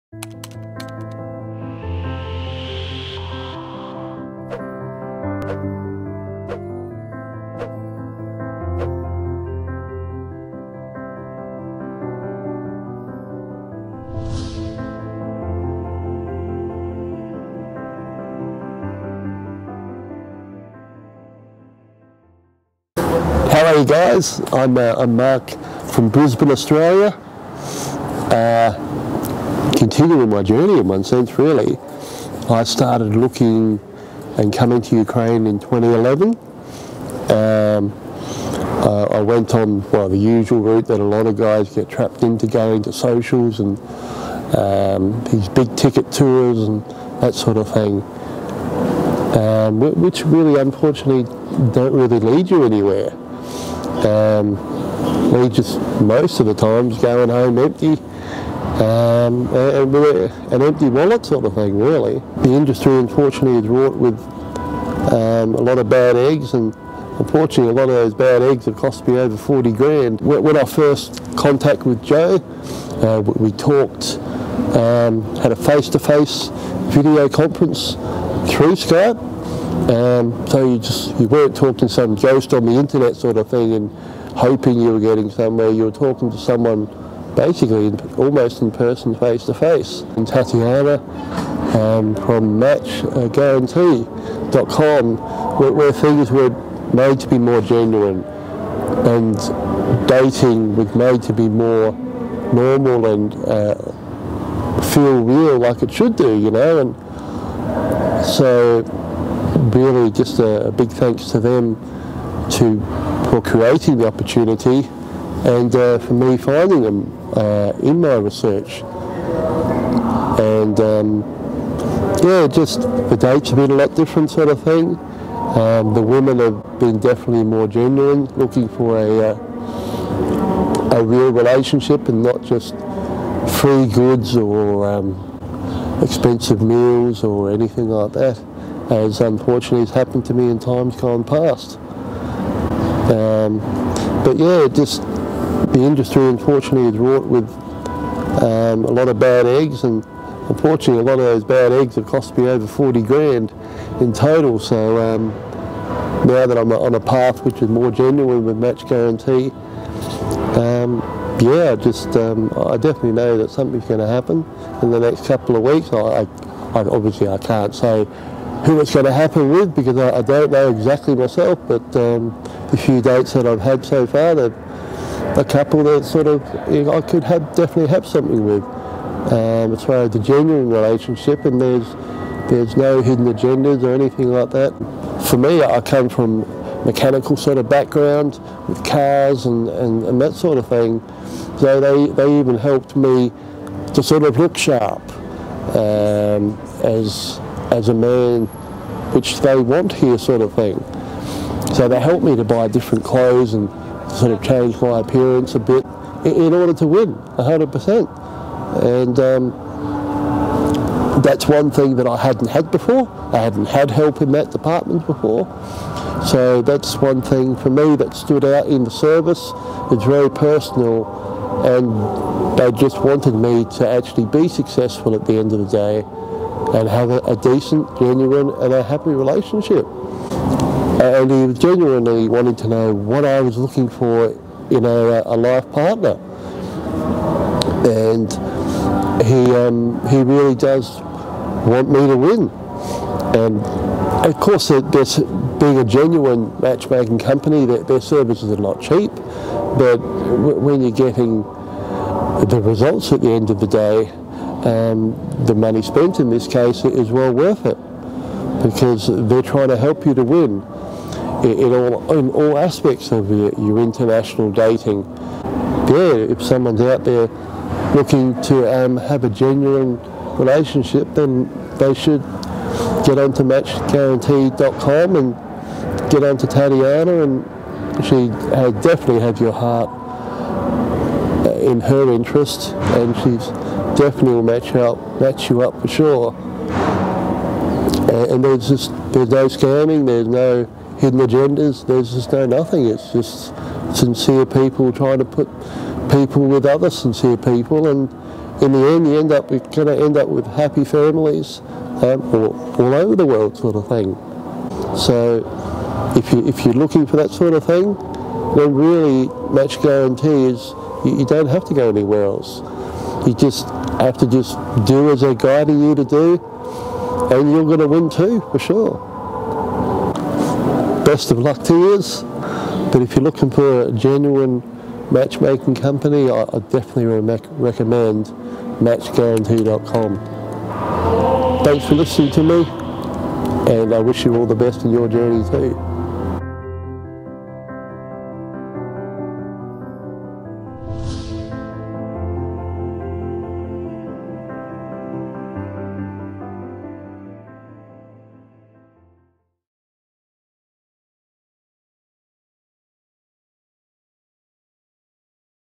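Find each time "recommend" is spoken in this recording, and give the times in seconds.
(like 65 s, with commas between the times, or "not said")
327 s.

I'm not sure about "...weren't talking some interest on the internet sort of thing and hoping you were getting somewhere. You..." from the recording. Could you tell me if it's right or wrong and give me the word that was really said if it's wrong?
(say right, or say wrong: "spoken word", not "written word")
wrong: "ghost", not "interest".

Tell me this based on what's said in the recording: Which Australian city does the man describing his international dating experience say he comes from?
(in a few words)
Brisbane.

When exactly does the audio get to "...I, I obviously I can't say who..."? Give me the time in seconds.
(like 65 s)
165 s.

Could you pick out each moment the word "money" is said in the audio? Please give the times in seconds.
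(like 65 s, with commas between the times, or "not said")
255 s.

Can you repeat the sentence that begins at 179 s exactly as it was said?
Um, as far as the genuine relationship, and there's there's no hidden agendas or anything like that.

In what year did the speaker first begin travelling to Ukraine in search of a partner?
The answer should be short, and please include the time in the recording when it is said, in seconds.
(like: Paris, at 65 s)
2011, at 35 s.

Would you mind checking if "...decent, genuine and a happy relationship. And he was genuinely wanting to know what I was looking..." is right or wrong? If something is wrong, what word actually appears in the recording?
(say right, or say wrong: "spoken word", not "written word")
right.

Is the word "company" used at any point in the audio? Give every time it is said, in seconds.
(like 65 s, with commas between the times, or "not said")
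247 s, 325 s.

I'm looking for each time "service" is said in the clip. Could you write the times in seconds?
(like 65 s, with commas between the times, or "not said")
218 s, 248 s.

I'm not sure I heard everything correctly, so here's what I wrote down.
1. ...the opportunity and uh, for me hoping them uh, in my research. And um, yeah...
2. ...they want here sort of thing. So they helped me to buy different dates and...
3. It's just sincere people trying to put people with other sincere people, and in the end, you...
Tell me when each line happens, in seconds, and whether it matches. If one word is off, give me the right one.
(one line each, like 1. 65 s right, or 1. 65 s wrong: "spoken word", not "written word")
1. 113 s wrong: "finding", not "hoping"
2. 199 s wrong: "clothes", not "dates"
3. 292 s right.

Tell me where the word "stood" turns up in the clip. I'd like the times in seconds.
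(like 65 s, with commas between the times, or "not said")
218 s.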